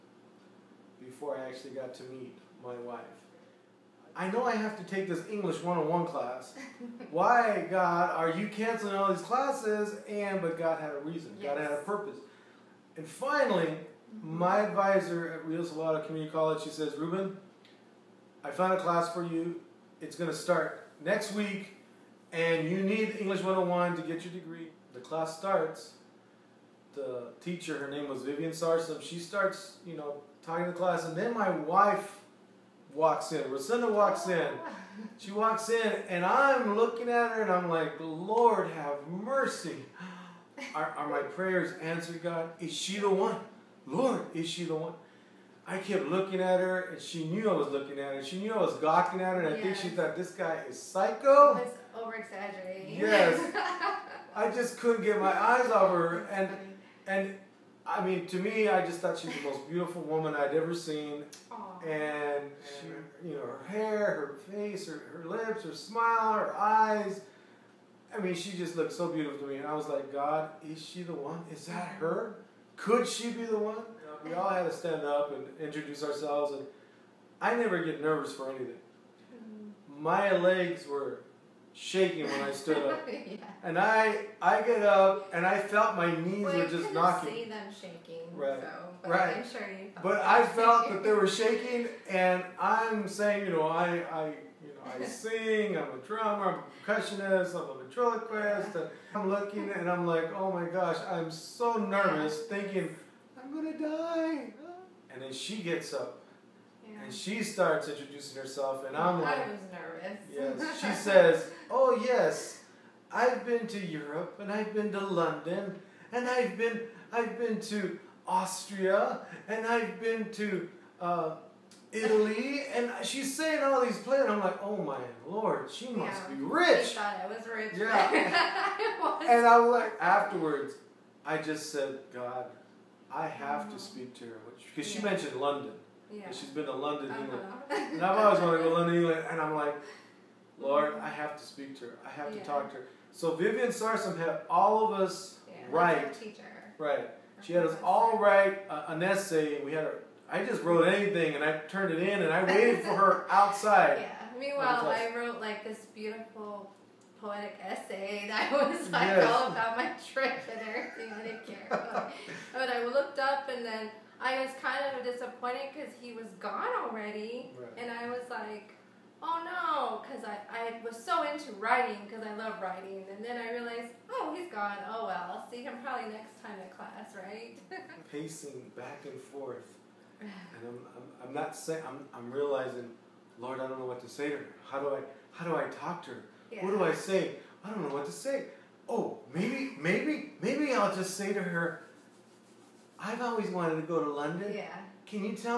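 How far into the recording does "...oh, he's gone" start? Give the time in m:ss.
2:54.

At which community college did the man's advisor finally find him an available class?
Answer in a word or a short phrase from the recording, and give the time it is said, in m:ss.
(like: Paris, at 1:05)
Rio Salado Community College, at 0:15.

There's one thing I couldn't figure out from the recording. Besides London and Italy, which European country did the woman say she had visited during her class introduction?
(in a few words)
Austria.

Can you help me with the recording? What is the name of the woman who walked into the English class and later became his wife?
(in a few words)
Rosenda.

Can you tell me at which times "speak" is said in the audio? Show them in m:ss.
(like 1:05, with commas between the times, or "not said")
2:13, 2:21.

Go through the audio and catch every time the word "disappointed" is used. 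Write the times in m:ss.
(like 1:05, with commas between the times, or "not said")
2:45.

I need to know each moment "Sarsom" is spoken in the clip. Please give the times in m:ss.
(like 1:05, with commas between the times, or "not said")
0:28, 2:23.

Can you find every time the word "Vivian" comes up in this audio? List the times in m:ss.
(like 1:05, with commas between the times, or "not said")
0:28, 2:23.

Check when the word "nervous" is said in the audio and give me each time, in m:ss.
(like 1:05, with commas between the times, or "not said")
1:18, 1:41, 1:49.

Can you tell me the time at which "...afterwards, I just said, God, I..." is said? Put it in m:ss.
2:10.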